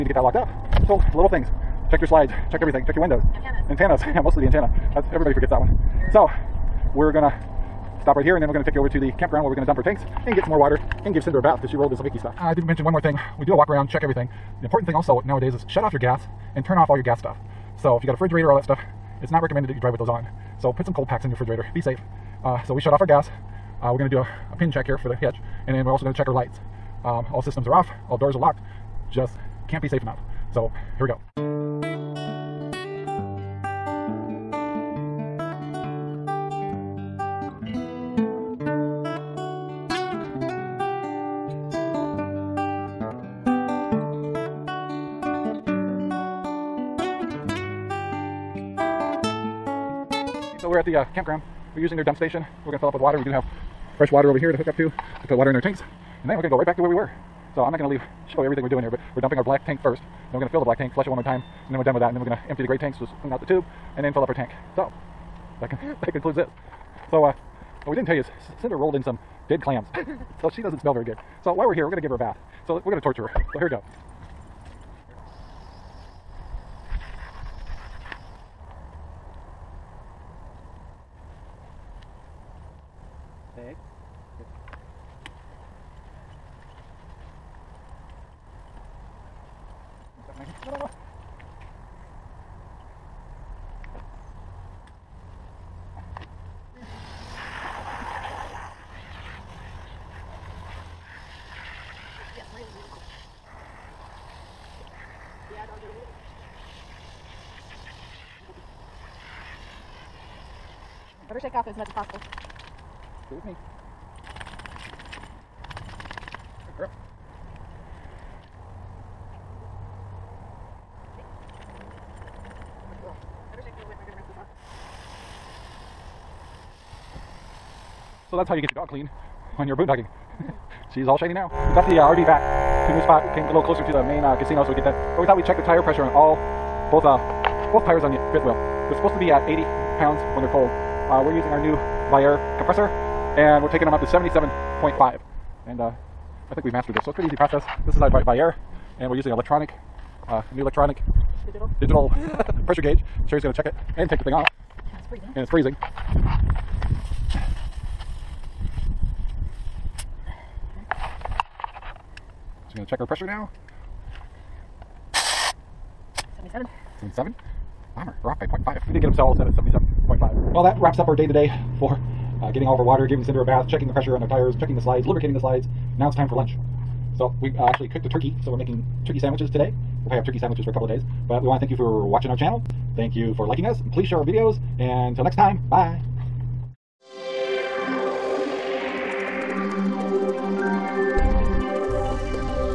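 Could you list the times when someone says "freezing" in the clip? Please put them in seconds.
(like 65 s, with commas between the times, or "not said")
155 s.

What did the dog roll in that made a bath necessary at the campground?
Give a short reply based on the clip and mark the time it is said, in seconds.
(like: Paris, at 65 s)
Dead clams, at 69 s.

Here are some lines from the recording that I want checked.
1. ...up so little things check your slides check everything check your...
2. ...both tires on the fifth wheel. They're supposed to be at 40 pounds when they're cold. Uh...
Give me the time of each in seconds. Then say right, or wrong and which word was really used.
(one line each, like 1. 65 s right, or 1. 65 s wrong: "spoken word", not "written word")
1. 0 s right
2. 137 s wrong: "80", not "40".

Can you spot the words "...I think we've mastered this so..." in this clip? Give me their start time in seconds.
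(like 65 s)
146 s.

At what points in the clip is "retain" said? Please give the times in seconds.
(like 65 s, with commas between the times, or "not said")
not said.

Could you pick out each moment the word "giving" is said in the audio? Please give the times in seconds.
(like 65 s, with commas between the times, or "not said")
173 s.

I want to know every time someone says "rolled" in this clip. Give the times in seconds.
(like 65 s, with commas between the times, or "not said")
11 s, 68 s.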